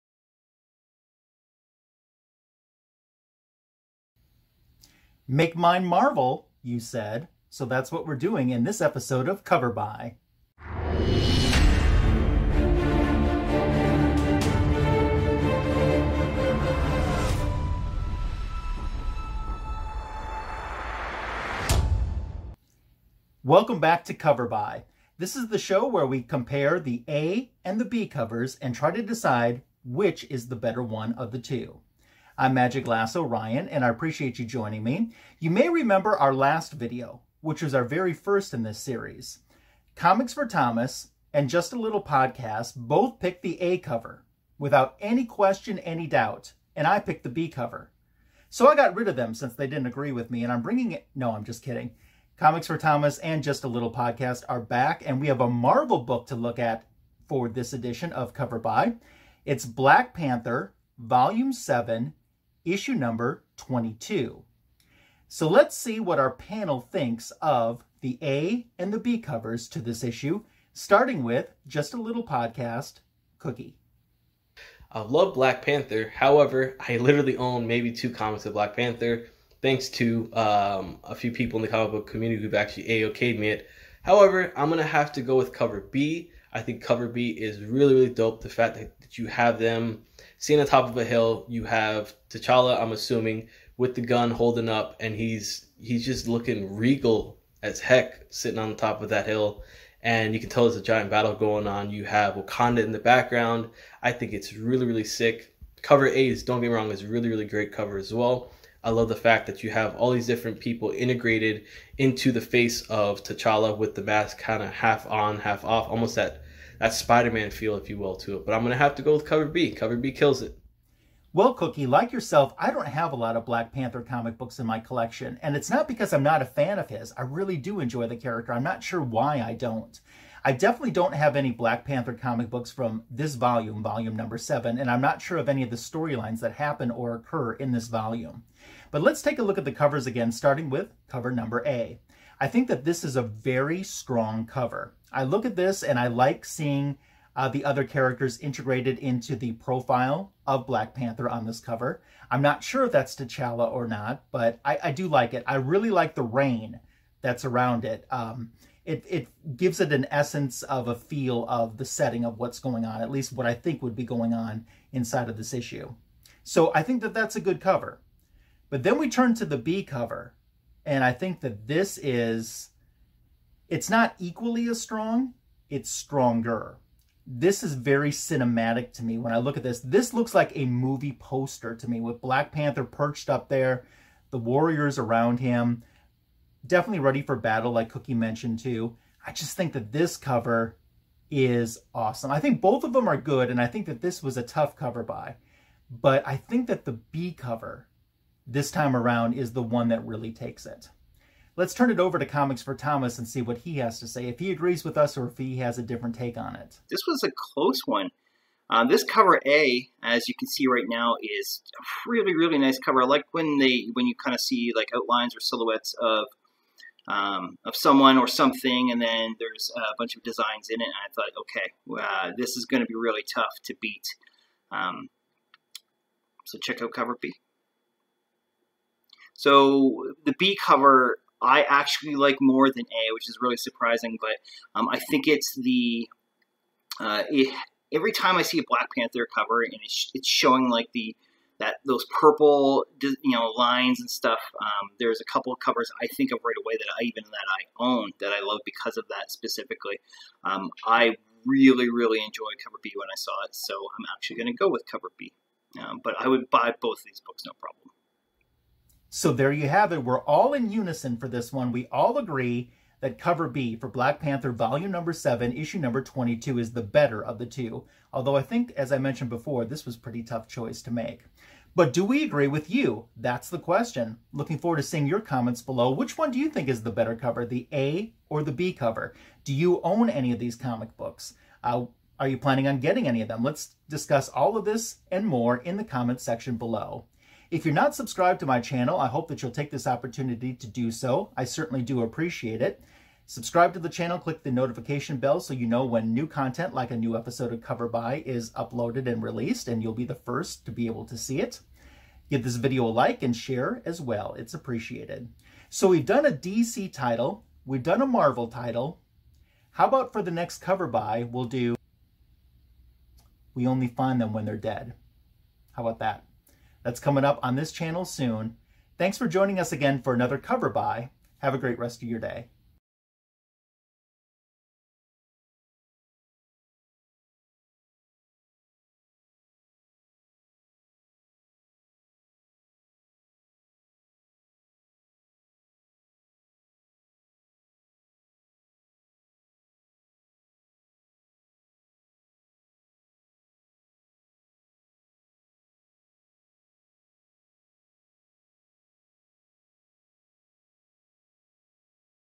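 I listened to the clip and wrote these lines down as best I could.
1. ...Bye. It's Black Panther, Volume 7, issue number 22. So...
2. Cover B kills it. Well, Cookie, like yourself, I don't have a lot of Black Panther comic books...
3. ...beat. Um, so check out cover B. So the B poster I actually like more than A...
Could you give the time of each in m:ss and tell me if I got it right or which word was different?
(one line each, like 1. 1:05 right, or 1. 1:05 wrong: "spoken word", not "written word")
1. 0:58 right
2. 1:59 right
3. 3:43 wrong: "cover", not "poster".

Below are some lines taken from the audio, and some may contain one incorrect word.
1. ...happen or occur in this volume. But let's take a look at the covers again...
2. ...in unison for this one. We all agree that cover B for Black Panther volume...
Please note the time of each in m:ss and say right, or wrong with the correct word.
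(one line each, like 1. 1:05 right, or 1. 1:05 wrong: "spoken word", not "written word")
1. 2:16 right
2. 4:20 right.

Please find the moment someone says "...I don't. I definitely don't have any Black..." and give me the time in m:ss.
2:09.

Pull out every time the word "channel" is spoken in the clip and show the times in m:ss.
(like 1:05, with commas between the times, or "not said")
4:48, 4:53, 5:17.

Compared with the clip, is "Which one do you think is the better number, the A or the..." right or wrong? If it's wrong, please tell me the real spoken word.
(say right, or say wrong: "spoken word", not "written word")
wrong: "cover", not "number".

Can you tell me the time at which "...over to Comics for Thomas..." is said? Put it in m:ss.
3:21.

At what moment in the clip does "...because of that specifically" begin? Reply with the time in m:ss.
4:08.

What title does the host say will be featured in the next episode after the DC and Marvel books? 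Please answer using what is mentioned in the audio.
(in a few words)
We Only Find Them When They're Dead.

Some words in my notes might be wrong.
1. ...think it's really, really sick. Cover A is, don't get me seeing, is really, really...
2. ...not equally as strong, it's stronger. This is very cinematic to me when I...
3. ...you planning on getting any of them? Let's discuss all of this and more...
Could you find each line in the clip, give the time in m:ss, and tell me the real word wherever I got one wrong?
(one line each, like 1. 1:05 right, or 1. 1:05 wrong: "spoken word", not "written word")
1. 1:44 wrong: "wrong", not "seeing"
2. 2:53 right
3. 4:42 right.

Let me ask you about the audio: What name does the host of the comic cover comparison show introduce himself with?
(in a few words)
Magic Lasso Ryan.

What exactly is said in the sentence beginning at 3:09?
I just think that this cover is awesome.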